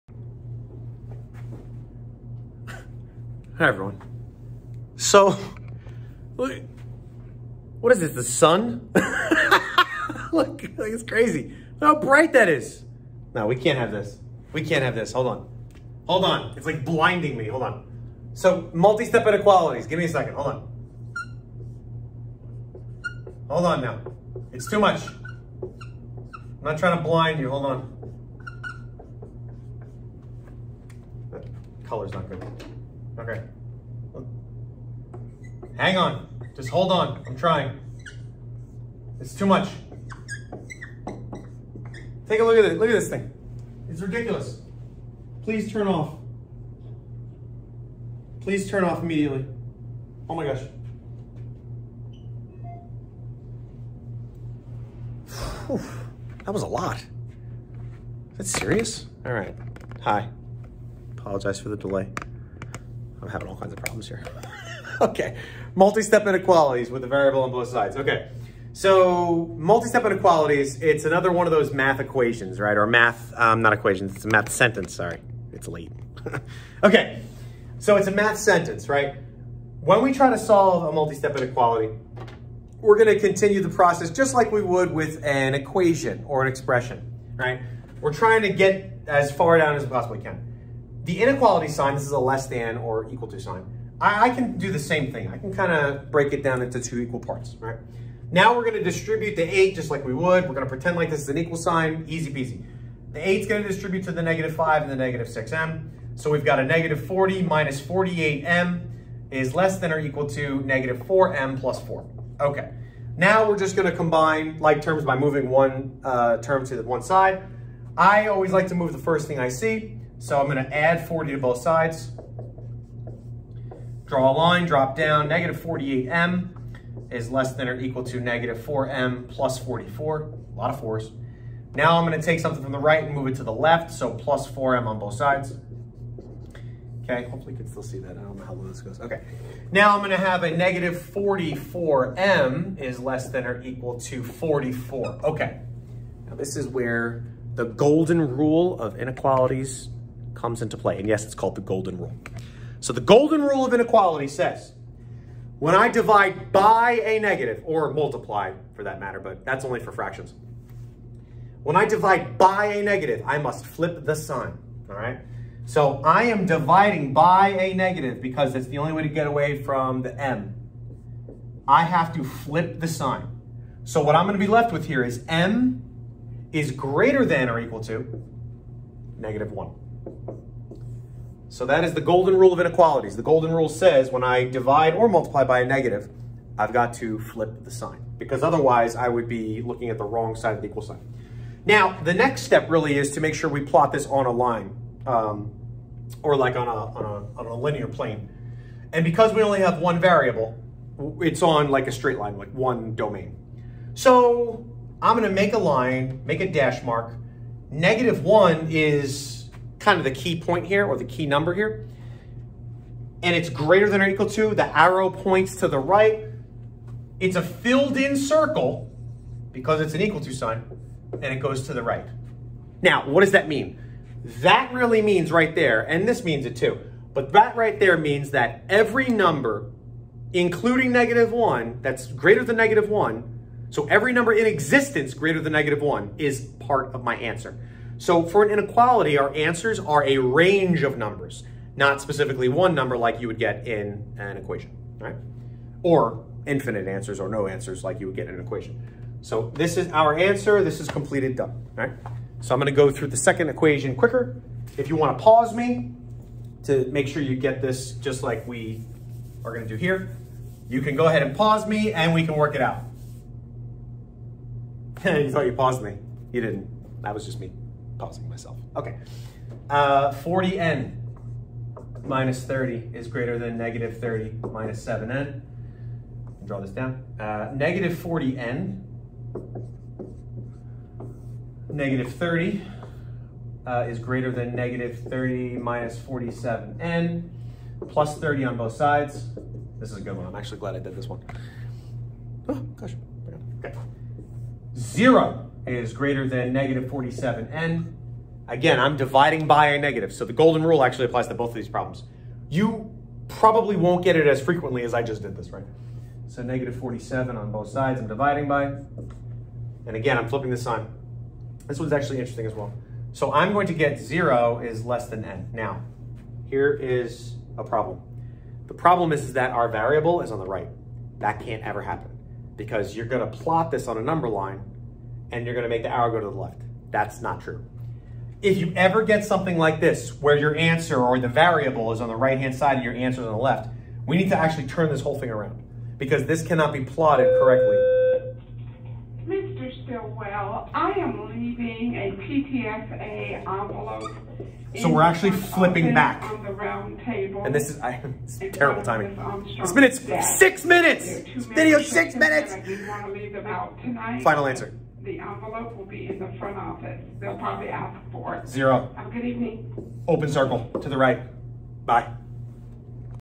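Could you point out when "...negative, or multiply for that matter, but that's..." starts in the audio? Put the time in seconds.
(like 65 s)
157 s.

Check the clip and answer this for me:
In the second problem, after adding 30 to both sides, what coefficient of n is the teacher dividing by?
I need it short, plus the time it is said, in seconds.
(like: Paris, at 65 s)
-47, at 306 s.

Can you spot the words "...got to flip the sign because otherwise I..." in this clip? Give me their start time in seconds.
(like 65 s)
186 s.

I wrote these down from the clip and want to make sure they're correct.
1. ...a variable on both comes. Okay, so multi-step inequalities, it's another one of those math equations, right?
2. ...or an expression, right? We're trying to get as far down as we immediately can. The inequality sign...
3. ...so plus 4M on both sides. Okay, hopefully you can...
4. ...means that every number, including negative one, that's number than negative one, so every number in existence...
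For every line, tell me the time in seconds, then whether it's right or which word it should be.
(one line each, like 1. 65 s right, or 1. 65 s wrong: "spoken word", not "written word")
1. 67 s wrong: "sides", not "comes"
2. 86 s wrong: "possibly", not "immediately"
3. 133 s right
4. 227 s wrong: "greater", not "number".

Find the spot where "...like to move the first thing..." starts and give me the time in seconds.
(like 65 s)
118 s.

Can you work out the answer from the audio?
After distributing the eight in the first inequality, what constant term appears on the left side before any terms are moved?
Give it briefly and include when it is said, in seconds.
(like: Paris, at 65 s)
-40, at 106 s.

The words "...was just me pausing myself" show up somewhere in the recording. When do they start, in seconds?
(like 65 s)
267 s.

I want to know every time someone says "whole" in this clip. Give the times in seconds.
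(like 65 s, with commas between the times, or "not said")
335 s.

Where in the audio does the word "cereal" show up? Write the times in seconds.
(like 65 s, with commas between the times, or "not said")
not said.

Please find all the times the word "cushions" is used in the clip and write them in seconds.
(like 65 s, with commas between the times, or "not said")
not said.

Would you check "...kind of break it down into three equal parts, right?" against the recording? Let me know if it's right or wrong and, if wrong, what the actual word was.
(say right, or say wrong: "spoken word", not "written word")
wrong: "two", not "three".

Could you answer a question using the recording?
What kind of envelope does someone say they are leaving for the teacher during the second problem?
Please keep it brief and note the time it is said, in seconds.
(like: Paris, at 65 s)
PTFA envelope, at 342 s.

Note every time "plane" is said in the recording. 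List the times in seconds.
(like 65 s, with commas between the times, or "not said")
197 s.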